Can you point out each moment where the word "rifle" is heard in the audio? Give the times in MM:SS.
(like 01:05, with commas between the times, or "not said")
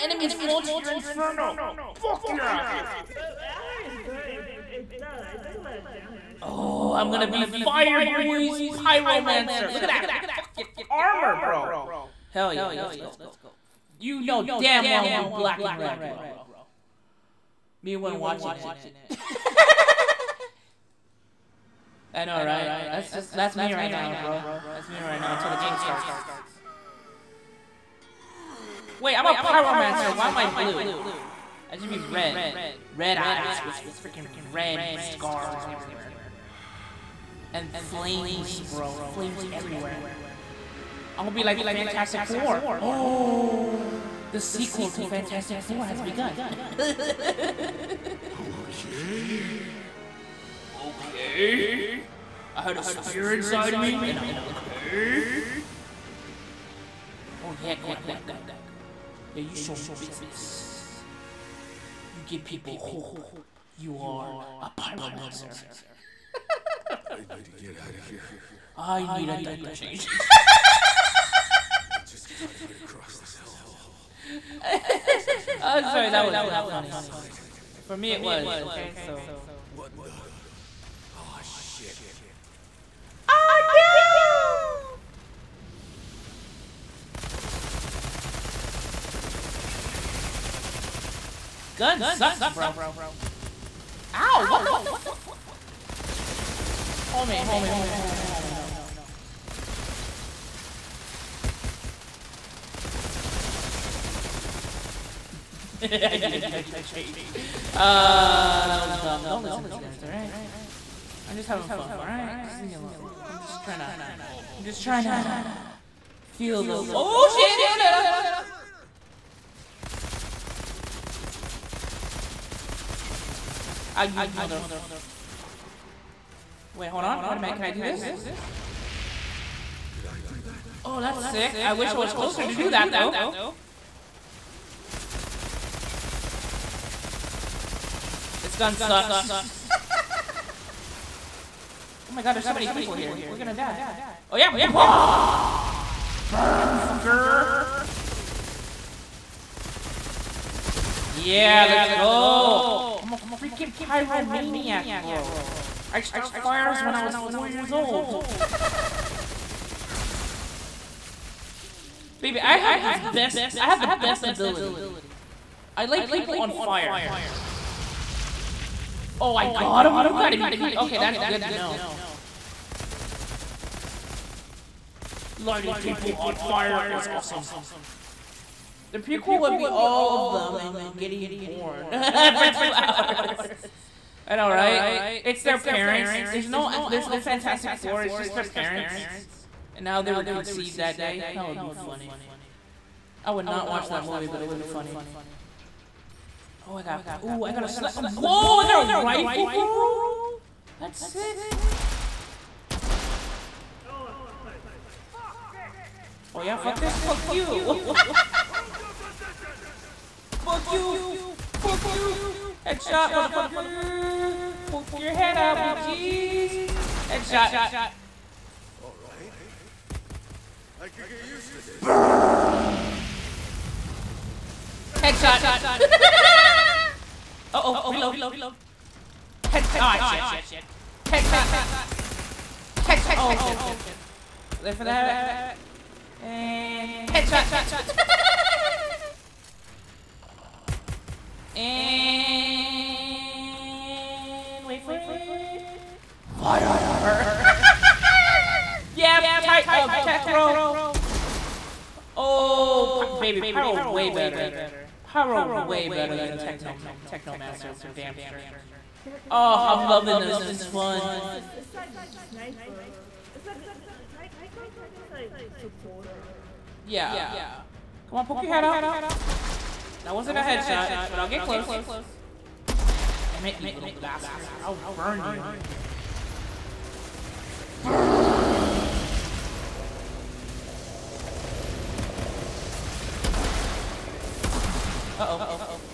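03:18.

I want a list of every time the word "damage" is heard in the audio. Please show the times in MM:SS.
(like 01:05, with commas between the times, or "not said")
00:05.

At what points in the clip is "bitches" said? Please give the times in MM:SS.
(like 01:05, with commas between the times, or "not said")
03:35.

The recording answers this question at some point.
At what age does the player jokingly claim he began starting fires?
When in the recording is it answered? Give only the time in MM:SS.
02:37.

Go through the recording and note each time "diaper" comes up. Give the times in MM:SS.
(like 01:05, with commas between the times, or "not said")
01:09.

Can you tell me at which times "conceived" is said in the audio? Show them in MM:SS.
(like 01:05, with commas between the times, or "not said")
03:10.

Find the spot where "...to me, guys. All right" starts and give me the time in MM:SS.
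01:49.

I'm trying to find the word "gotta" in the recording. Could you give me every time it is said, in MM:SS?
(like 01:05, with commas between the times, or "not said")
01:12, 02:50.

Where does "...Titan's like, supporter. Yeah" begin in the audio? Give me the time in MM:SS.
04:24.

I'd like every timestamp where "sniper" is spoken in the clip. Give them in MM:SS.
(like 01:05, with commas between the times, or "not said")
03:17, 04:22.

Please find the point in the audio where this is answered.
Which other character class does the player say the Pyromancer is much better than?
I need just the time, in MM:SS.
04:17.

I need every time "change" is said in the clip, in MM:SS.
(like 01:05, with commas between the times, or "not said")
01:09, 01:46.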